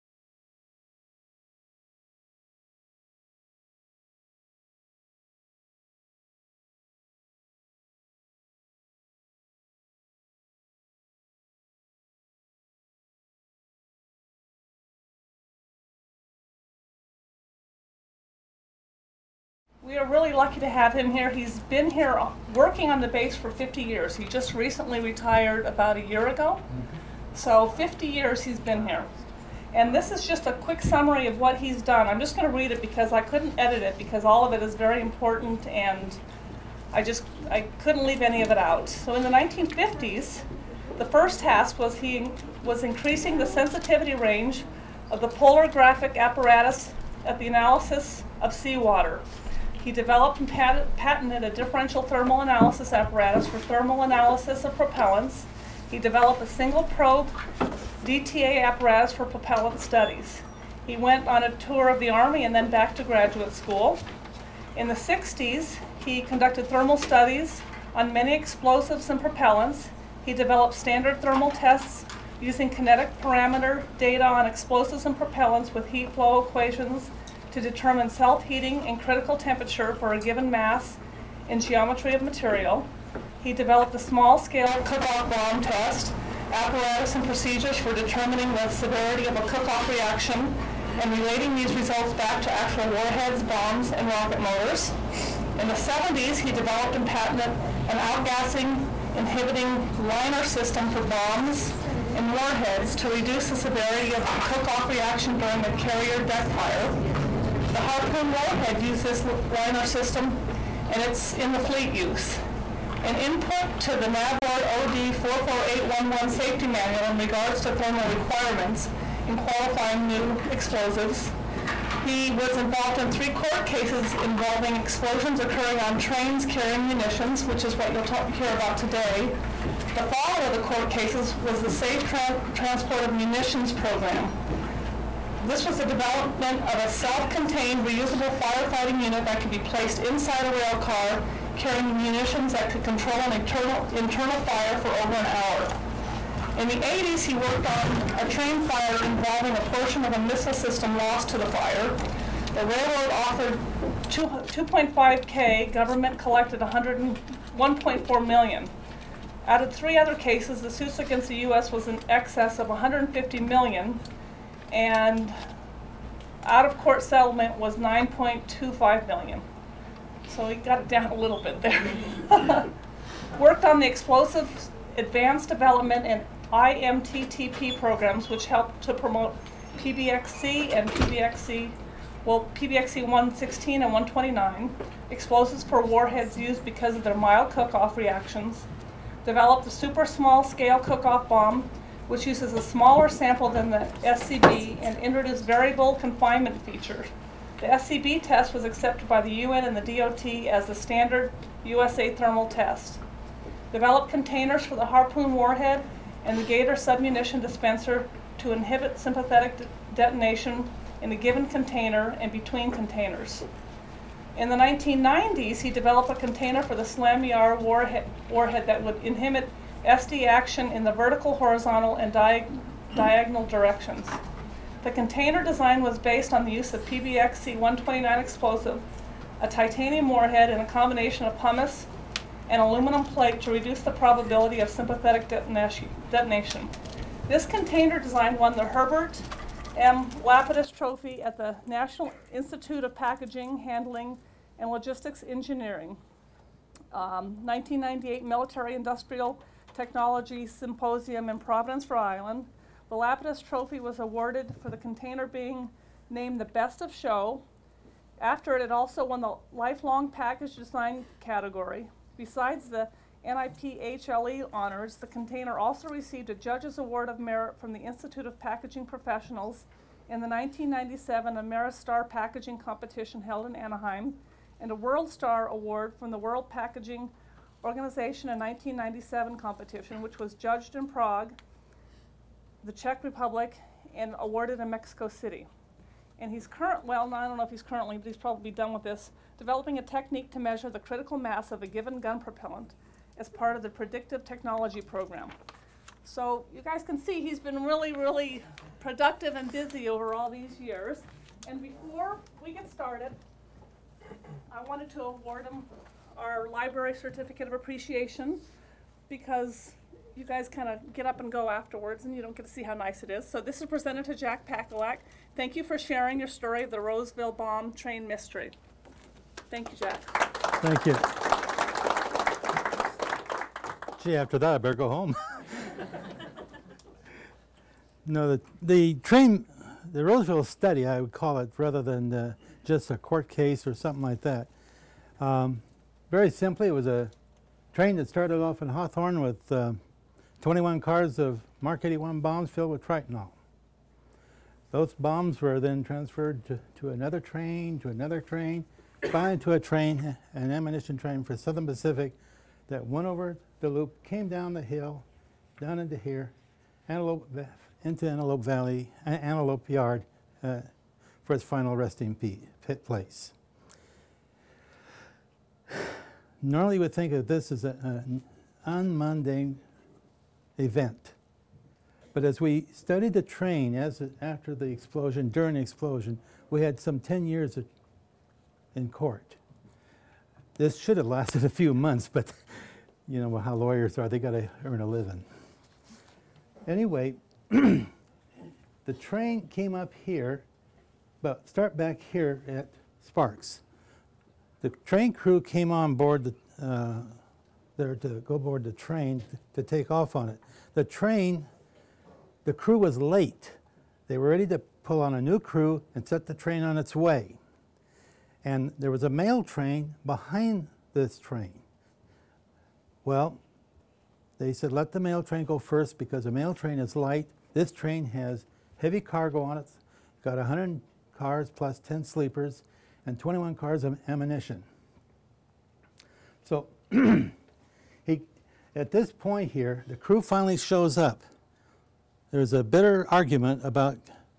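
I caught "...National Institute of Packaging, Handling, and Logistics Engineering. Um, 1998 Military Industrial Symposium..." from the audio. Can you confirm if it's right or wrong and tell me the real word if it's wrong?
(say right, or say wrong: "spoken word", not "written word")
wrong: "Technology", not "Symposium".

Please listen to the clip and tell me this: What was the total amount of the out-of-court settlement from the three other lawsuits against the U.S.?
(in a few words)
9.25 million.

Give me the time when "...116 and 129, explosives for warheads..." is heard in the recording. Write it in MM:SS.
03:03.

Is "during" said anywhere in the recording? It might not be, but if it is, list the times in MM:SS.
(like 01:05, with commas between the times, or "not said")
01:45, 06:15.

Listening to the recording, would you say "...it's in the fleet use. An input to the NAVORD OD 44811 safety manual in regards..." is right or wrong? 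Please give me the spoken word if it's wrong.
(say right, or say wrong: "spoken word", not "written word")
right.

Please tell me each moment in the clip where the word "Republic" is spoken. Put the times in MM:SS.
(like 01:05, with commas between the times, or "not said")
04:43.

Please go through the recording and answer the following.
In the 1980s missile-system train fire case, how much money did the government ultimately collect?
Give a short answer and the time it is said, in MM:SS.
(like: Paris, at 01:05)
1.4 million, at 02:36.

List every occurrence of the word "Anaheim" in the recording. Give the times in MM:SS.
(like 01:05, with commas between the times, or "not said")
04:33.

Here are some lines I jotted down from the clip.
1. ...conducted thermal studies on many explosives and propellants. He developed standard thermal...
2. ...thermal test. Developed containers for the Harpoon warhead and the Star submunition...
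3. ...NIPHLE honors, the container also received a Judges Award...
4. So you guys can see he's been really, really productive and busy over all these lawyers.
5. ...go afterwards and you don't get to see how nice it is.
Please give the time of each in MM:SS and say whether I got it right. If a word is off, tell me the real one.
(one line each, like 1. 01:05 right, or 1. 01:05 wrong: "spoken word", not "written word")
1. 01:06 right
2. 03:22 wrong: "Gator", not "Star"
3. 04:23 right
4. 04:56 wrong: "years", not "lawyers"
5. 05:11 right.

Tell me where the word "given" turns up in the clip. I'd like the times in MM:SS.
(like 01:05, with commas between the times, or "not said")
01:20, 03:31, 04:51.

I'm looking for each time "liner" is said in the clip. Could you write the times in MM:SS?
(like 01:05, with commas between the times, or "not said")
01:39, 01:49.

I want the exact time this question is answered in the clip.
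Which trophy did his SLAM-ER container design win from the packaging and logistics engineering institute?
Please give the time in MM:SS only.
03:58.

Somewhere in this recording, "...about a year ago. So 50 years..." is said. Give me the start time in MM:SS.
00:25.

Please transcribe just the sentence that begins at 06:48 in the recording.
And there was a mail train behind this train.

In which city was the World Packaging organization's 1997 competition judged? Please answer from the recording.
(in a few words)
Prague.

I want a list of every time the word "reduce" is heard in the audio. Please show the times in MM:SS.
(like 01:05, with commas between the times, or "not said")
01:43, 03:53.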